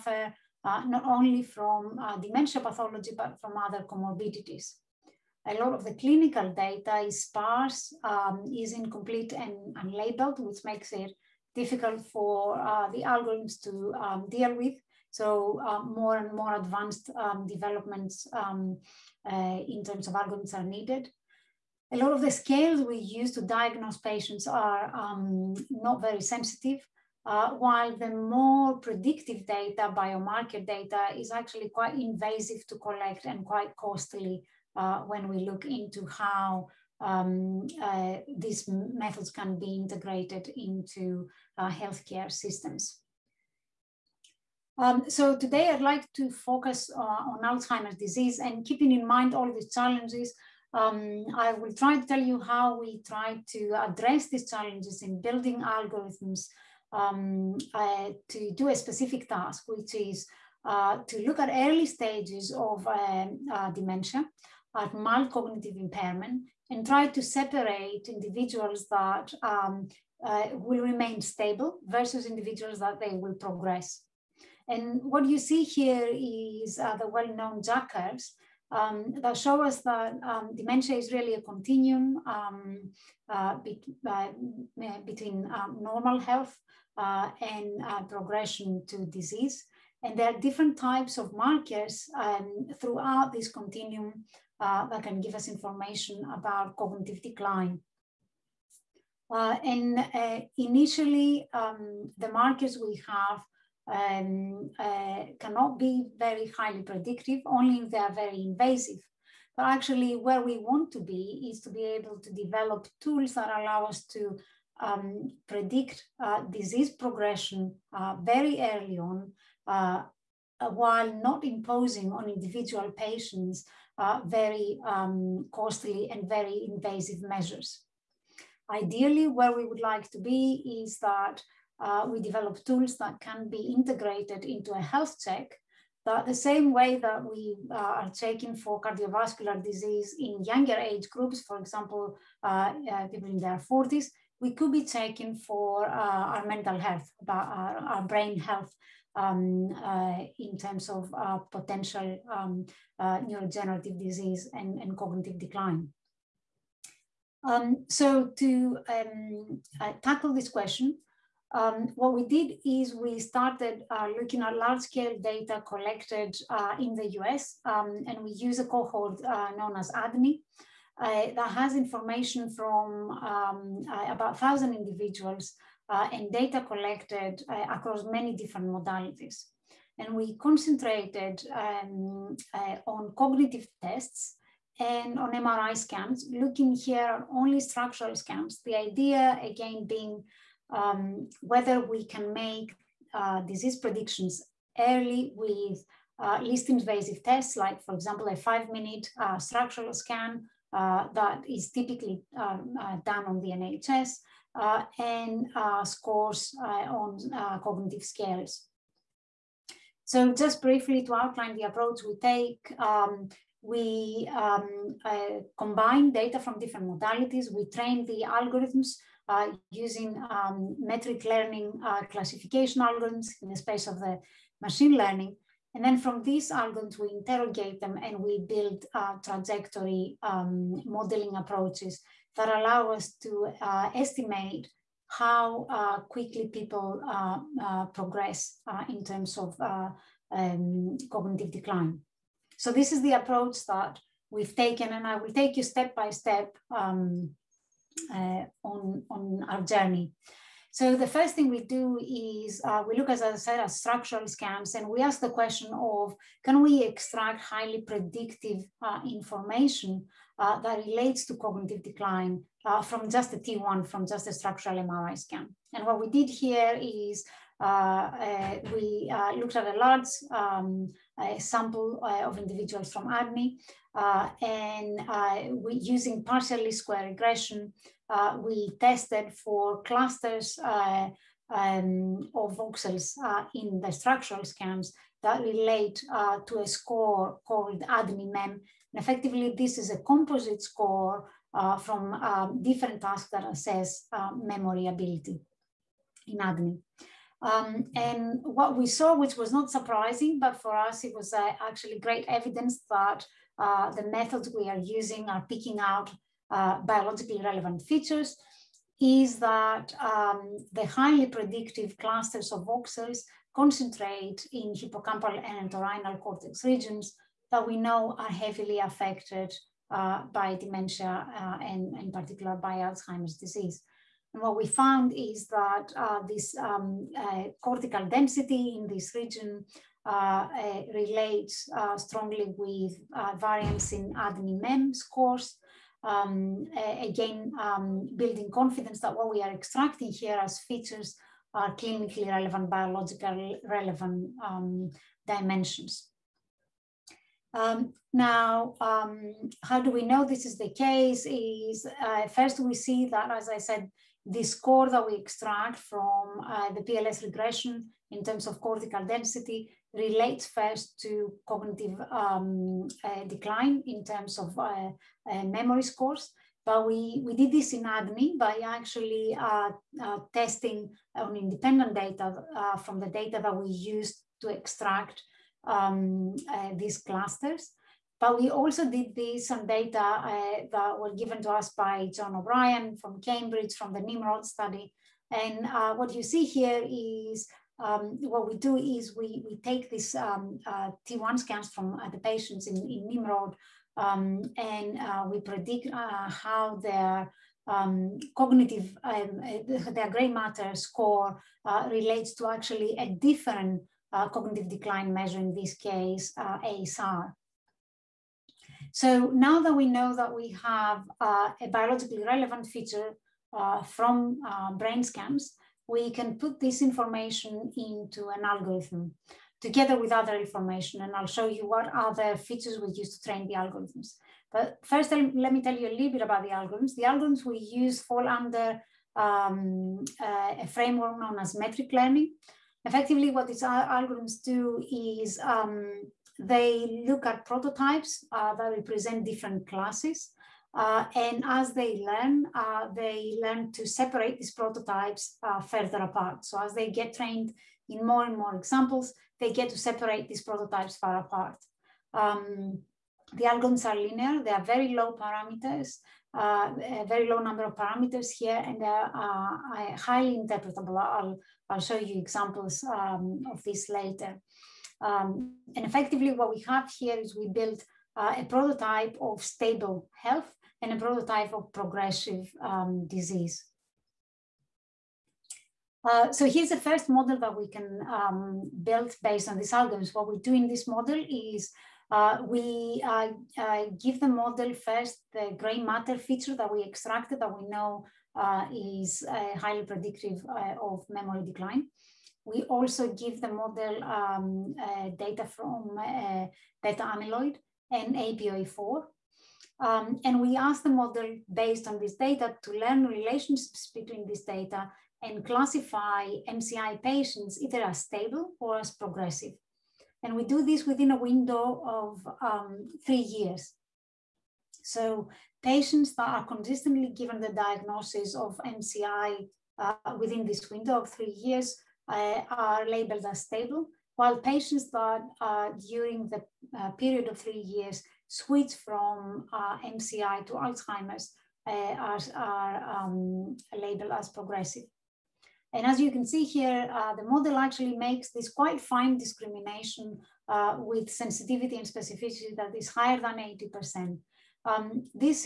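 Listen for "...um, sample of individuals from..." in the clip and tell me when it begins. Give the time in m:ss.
4:30.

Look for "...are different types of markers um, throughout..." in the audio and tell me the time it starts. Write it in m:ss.
1:30.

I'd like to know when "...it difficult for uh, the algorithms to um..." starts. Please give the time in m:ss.
0:10.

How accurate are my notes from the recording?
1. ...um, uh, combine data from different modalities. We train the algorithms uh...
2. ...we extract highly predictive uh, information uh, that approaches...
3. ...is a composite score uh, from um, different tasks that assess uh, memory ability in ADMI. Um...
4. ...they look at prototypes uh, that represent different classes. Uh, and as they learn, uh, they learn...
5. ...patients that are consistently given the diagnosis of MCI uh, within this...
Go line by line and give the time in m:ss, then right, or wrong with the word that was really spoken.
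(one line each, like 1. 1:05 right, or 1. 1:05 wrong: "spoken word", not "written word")
1. 3:34 right
2. 4:16 wrong: "relates", not "approaches"
3. 4:49 right
4. 7:16 right
5. 8:35 right.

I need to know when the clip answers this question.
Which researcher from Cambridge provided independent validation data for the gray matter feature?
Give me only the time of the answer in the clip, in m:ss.
6:22.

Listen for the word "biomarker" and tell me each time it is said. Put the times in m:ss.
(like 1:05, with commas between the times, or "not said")
0:29.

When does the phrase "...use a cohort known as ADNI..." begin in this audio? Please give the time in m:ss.
2:48.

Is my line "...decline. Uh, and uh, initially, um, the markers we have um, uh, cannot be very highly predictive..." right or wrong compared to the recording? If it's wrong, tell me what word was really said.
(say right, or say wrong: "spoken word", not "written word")
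right.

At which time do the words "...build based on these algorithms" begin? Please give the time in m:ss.
7:58.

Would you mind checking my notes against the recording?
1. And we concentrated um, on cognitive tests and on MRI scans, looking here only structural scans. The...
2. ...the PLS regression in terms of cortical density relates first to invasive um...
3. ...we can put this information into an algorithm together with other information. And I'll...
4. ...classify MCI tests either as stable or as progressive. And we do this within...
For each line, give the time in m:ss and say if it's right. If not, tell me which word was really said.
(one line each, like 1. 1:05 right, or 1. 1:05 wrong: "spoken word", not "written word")
1. 2:59 right
2. 5:56 wrong: "cognitive", not "invasive"
3. 6:55 right
4. 8:25 wrong: "patients", not "tests".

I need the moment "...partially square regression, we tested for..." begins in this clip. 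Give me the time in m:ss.
4:36.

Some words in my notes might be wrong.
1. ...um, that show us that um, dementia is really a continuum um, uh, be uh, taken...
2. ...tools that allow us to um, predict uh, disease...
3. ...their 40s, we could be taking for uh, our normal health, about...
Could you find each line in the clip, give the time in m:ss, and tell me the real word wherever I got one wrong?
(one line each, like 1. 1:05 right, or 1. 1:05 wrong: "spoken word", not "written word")
1. 1:18 wrong: "between", not "taken"
2. 1:53 right
3. 2:23 wrong: "mental", not "normal".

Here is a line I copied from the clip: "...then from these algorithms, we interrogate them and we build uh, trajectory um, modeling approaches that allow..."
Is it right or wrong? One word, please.
right.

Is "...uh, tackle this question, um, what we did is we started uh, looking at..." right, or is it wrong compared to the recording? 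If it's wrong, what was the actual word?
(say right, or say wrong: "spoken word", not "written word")
right.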